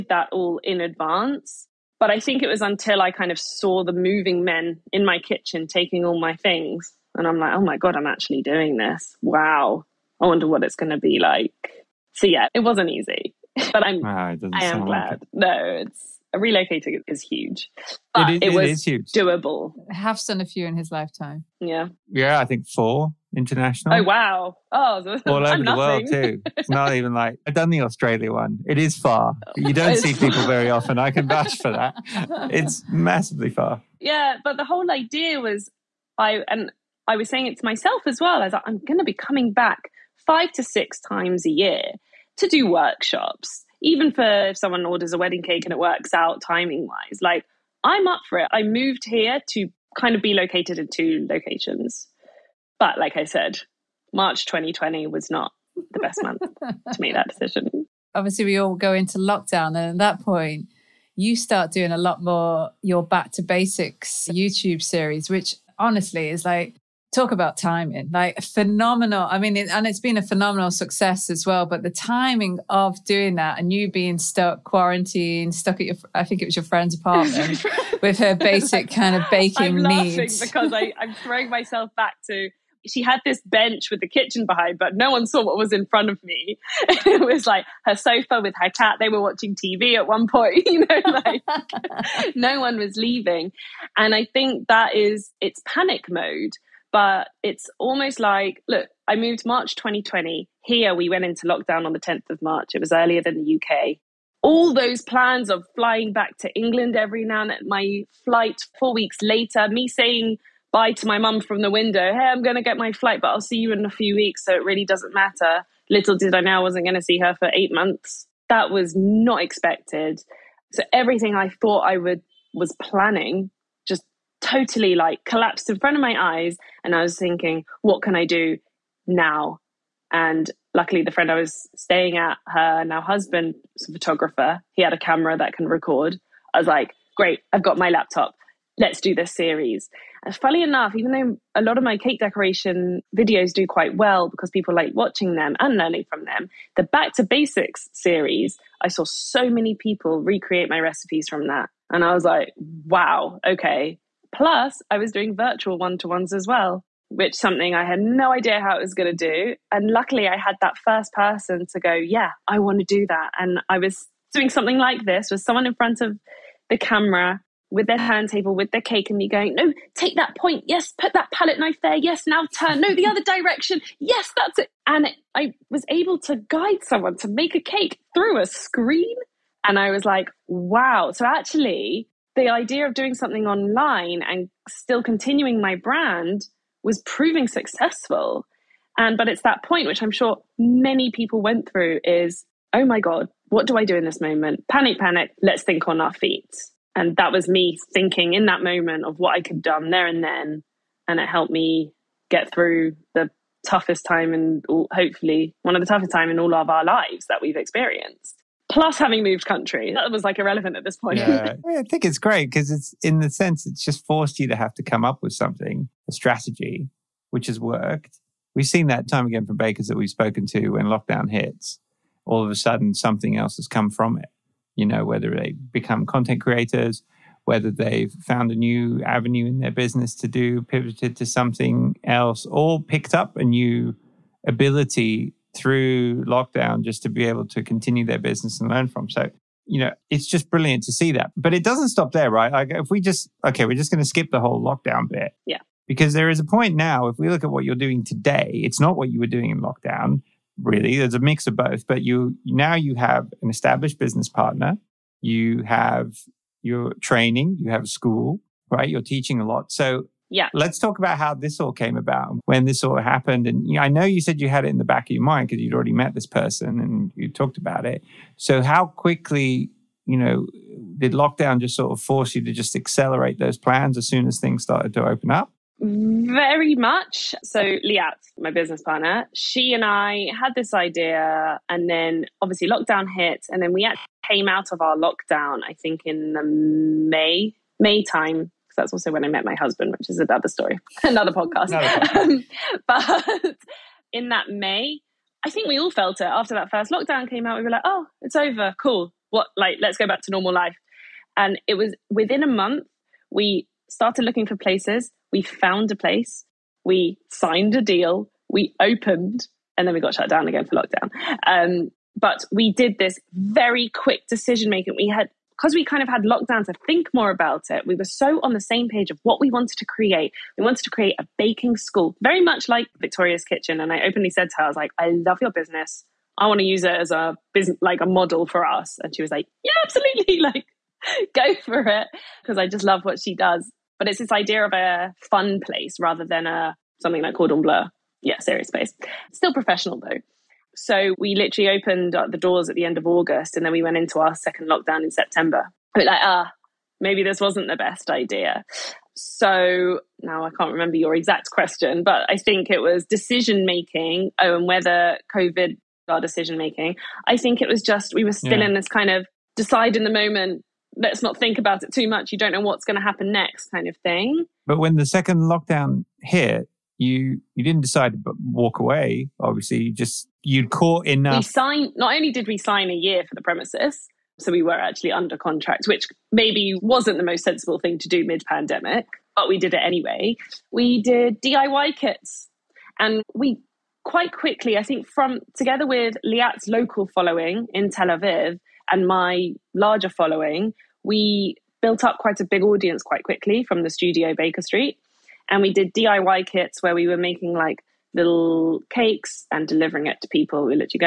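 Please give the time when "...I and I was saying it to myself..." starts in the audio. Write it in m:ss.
0:36.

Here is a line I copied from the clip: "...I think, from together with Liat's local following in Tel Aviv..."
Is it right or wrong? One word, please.
right.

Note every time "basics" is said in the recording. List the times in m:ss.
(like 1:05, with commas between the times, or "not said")
1:03, 1:18, 2:27.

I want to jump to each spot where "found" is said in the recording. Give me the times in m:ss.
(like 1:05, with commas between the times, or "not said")
3:48, 5:05.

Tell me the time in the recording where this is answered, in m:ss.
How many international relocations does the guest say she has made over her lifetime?
0:22.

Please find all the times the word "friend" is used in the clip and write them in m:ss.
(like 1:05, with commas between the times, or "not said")
1:16, 2:11.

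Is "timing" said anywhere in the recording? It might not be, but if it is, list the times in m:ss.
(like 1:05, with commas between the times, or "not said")
0:46, 1:07, 1:11.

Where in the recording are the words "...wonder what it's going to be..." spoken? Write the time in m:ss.
0:10.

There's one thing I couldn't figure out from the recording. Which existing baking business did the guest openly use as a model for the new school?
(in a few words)
Victoria's Kitchen.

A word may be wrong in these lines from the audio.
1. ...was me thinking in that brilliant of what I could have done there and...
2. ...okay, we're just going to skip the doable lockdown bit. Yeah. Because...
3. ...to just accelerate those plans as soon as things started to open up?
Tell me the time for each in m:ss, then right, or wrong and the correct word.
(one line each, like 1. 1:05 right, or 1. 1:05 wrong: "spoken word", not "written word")
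1. 3:17 wrong: "moment", not "brilliant"
2. 4:03 wrong: "whole", not "doable"
3. 4:32 right.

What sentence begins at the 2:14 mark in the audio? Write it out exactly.
He had a camera that can record.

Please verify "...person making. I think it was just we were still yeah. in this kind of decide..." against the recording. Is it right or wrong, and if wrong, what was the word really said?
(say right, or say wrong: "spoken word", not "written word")
wrong: "decision", not "person".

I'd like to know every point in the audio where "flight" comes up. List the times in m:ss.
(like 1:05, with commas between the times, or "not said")
1:48, 1:52.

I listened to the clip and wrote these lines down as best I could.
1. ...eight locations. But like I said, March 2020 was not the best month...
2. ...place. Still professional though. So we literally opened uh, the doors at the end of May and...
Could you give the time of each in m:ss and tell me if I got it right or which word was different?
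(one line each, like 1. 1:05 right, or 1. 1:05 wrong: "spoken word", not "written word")
1. 0:50 wrong: "two", not "eight"
2. 5:38 wrong: "August", not "May".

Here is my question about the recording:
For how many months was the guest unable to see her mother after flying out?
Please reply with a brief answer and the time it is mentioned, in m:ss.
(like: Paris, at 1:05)
8, at 1:57.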